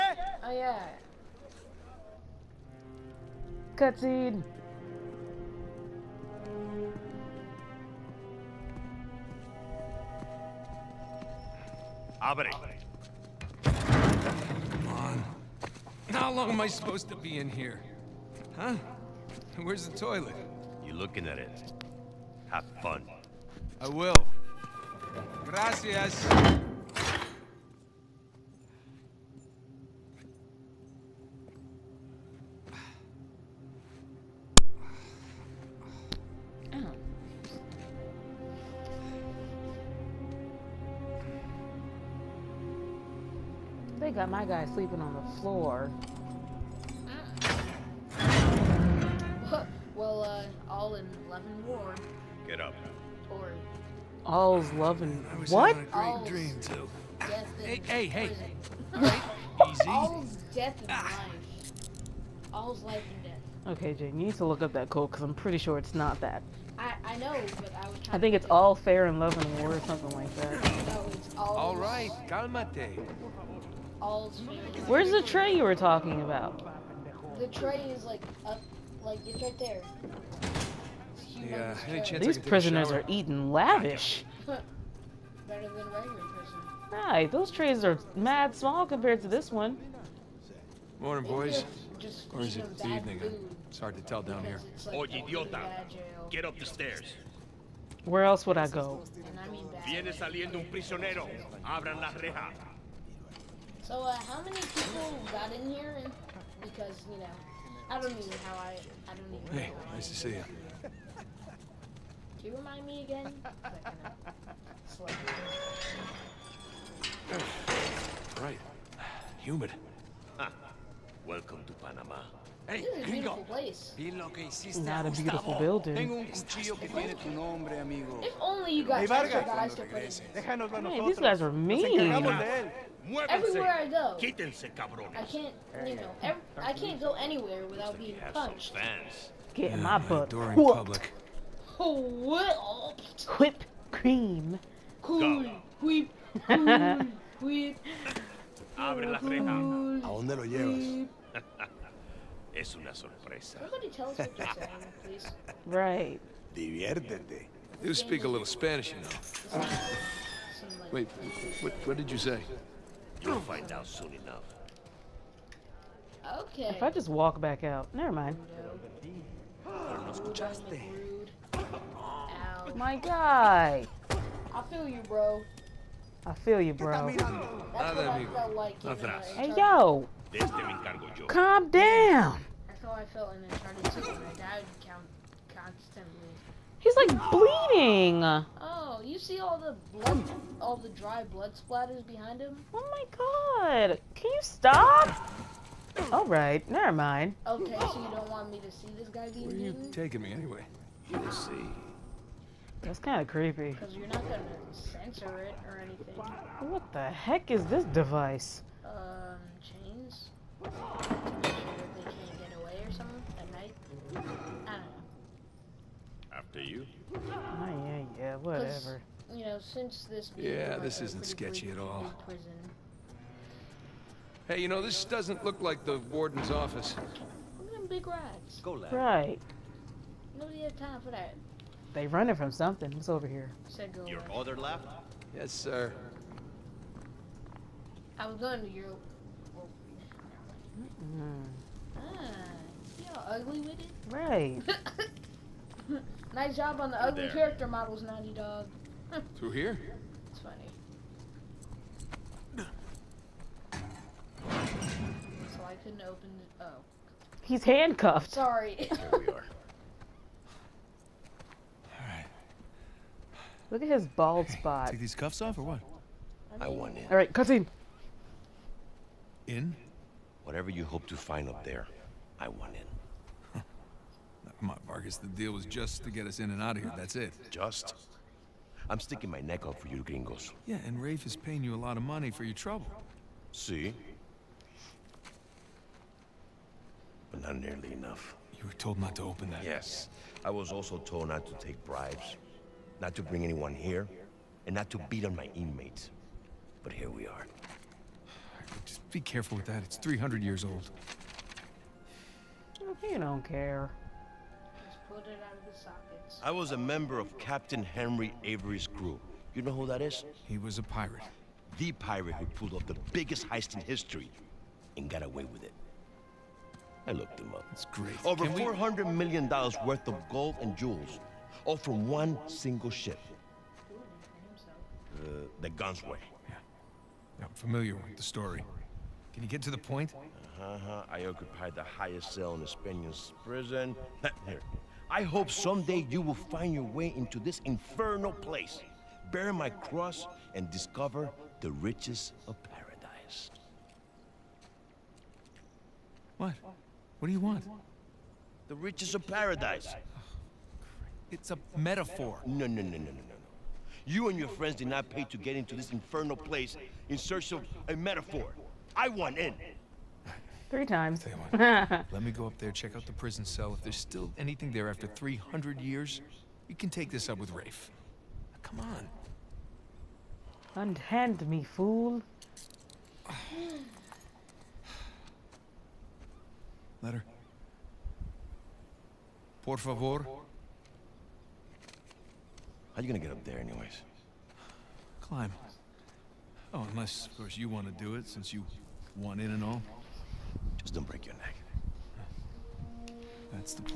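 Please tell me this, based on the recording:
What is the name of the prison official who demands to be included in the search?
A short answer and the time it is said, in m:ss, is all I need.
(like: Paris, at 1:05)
Vargas, at 4:34.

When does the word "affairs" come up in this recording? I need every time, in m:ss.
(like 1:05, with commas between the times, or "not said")
not said.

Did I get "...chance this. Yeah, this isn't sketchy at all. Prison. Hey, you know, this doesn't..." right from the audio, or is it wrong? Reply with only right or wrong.
wrong.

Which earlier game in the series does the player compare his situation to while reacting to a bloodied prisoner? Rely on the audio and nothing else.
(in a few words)
Uncharted 2.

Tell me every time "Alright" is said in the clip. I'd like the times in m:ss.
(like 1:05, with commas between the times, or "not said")
4:22, 4:27.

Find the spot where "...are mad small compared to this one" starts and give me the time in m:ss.
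1:27.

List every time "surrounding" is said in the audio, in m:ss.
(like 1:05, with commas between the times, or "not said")
not said.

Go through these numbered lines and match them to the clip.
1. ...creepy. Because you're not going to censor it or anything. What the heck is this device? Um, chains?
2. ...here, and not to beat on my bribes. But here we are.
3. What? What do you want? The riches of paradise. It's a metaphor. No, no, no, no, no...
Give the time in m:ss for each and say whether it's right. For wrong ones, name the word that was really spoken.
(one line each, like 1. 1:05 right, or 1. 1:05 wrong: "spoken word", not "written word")
1. 3:23 right
2. 4:53 wrong: "inmates", not "bribes"
3. 5:46 right.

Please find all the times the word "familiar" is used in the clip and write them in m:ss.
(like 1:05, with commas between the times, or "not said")
5:27.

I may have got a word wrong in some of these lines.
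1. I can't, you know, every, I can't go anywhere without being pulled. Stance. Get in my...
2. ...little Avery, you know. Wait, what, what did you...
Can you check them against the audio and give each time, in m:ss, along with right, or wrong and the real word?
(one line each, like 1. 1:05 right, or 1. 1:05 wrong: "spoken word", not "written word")
1. 2:15 wrong: "punched", not "pulled"
2. 2:38 wrong: "Spanish", not "Avery".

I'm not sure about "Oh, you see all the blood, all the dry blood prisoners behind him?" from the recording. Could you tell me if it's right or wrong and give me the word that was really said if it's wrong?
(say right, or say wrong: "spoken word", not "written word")
wrong: "splatters", not "prisoners".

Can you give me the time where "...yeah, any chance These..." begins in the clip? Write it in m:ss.
1:21.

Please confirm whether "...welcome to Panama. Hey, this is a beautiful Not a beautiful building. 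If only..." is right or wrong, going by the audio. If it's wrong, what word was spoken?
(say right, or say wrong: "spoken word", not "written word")
right.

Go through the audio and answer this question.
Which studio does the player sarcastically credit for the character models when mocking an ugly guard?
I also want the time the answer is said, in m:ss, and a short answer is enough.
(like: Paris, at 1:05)
Naughty Dog, at 4:08.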